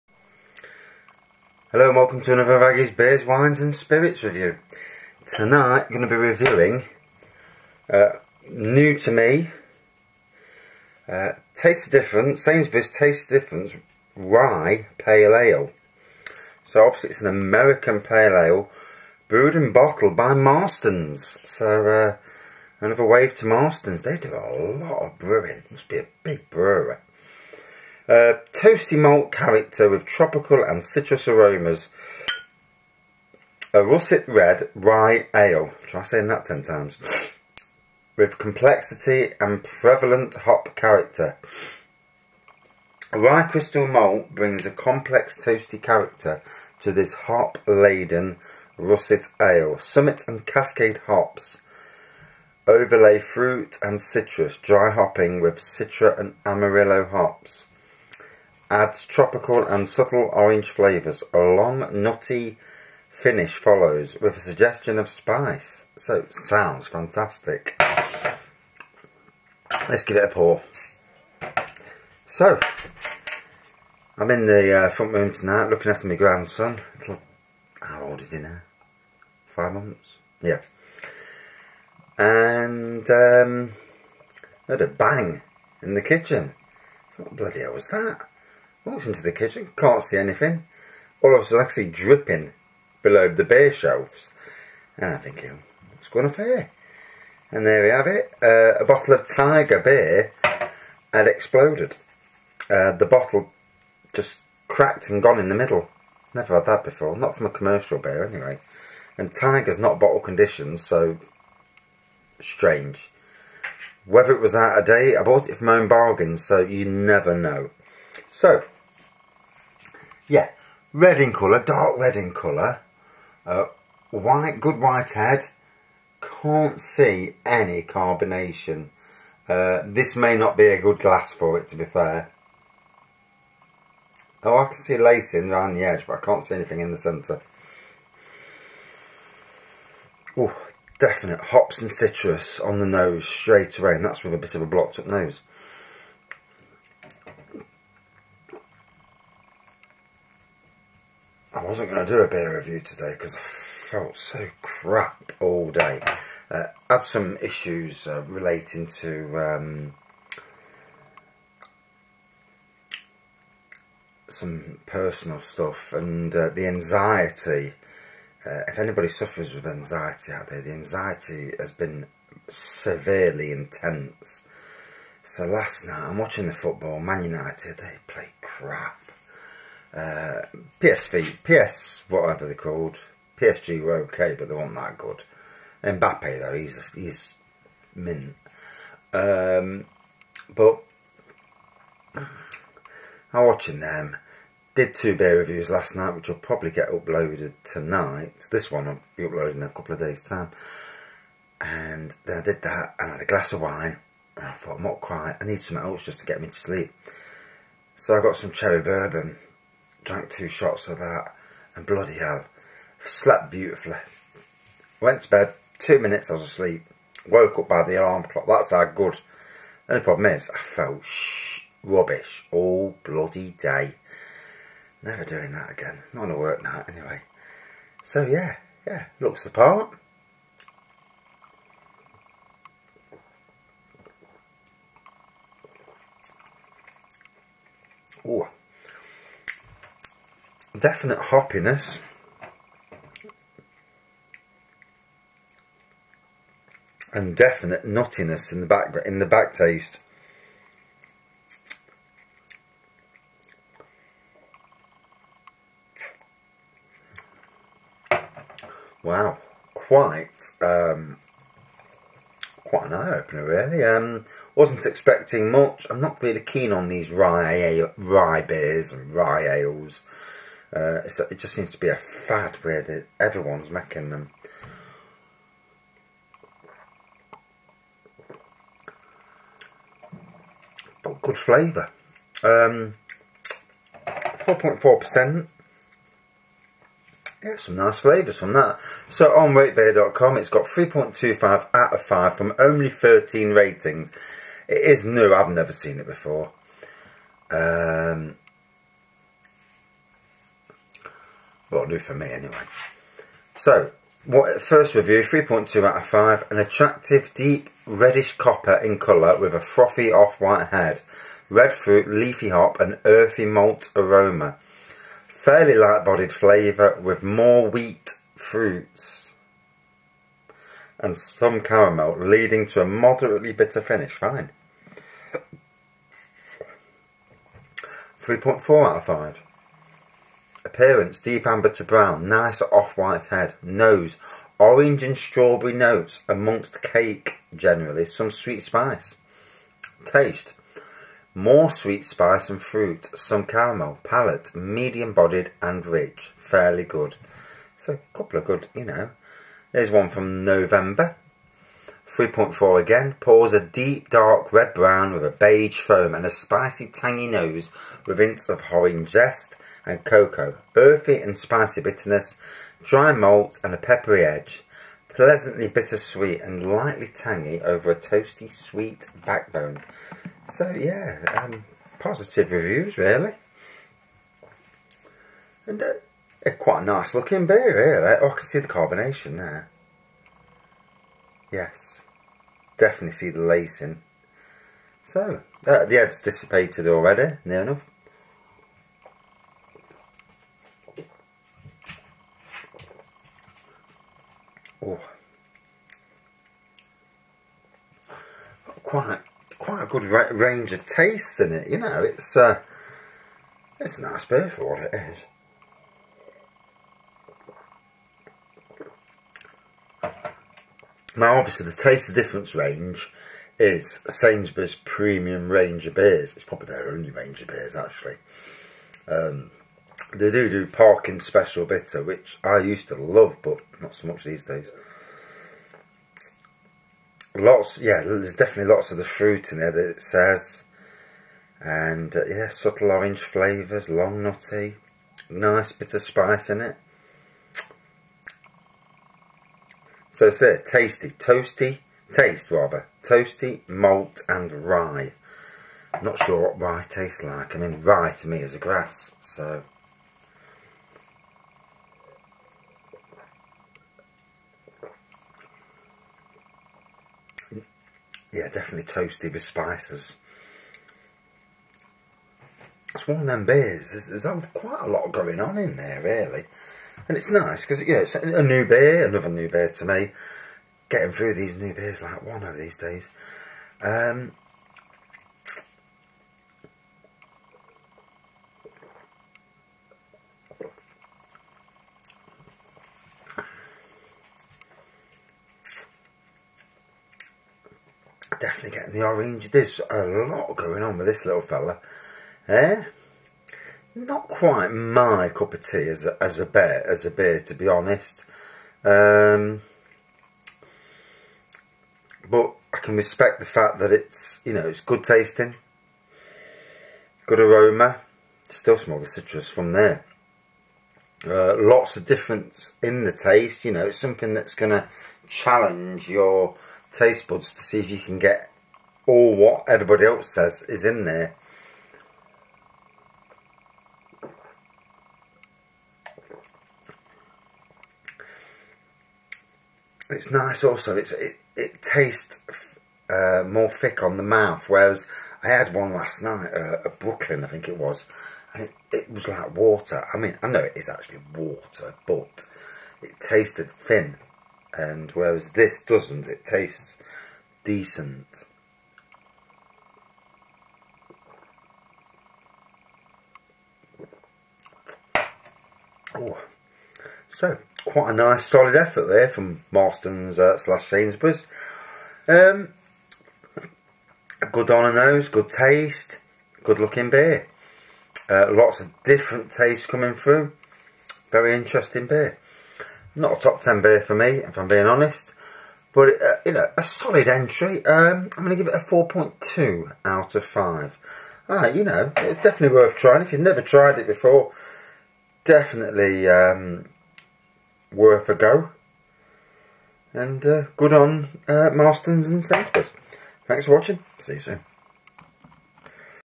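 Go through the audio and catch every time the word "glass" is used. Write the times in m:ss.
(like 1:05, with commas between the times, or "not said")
2:10, 3:23.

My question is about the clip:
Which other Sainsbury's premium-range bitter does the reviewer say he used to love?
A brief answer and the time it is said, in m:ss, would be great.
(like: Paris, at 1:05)
Parkin Special Bitter, at 7:00.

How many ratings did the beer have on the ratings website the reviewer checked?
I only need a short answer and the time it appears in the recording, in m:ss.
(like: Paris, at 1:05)
13, at 4:52.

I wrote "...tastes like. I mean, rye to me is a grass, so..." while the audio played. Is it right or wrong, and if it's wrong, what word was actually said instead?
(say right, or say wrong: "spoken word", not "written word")
right.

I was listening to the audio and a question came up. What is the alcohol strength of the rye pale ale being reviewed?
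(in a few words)
4.4%.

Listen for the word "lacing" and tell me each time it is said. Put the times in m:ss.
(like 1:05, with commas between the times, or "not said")
2:14, 6:23.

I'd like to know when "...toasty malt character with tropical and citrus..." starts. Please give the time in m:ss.
0:28.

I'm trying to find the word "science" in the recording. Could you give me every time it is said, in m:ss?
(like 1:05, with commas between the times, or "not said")
not said.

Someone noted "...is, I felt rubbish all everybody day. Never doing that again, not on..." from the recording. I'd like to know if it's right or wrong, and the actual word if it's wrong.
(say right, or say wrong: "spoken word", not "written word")
wrong: "bloody", not "everybody".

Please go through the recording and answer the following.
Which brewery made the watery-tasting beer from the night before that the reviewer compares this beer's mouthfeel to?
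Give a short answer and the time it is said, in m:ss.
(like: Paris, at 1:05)
Brooklyn, at 8:56.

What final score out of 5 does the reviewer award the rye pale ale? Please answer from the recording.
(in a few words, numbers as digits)
4.2.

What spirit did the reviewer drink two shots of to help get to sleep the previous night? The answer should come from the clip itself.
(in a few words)
cherry bourbon.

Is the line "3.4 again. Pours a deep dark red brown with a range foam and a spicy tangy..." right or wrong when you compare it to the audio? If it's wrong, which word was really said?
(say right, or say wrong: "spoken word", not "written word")
wrong: "beige", not "range".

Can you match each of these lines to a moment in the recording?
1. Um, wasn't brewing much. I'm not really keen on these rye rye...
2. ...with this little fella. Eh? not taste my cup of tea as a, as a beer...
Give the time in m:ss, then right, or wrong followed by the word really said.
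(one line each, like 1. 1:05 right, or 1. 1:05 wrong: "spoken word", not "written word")
1. 4:23 wrong: "expecting", not "brewing"
2. 8:10 wrong: "quite", not "taste".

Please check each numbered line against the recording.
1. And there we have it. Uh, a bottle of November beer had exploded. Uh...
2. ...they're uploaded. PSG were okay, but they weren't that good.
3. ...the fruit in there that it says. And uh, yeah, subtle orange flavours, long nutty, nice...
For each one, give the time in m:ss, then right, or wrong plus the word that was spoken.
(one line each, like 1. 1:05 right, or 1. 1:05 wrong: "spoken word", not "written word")
1. 1:37 wrong: "Tiger", not "November"
2. 3:02 wrong: "called", not "uploaded"
3. 7:08 right.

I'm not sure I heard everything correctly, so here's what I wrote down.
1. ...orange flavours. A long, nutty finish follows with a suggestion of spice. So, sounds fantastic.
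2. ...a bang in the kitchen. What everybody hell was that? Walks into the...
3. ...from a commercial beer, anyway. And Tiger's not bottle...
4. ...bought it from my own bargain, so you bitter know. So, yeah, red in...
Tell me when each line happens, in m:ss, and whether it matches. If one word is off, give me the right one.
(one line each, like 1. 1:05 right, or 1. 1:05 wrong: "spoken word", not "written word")
1. 1:00 right
2. 1:24 wrong: "bloody", not "everybody"
3. 1:47 right
4. 1:55 wrong: "never", not "bitter".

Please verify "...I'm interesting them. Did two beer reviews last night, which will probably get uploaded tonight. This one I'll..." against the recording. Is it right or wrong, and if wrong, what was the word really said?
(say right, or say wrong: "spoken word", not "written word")
wrong: "watching", not "interesting".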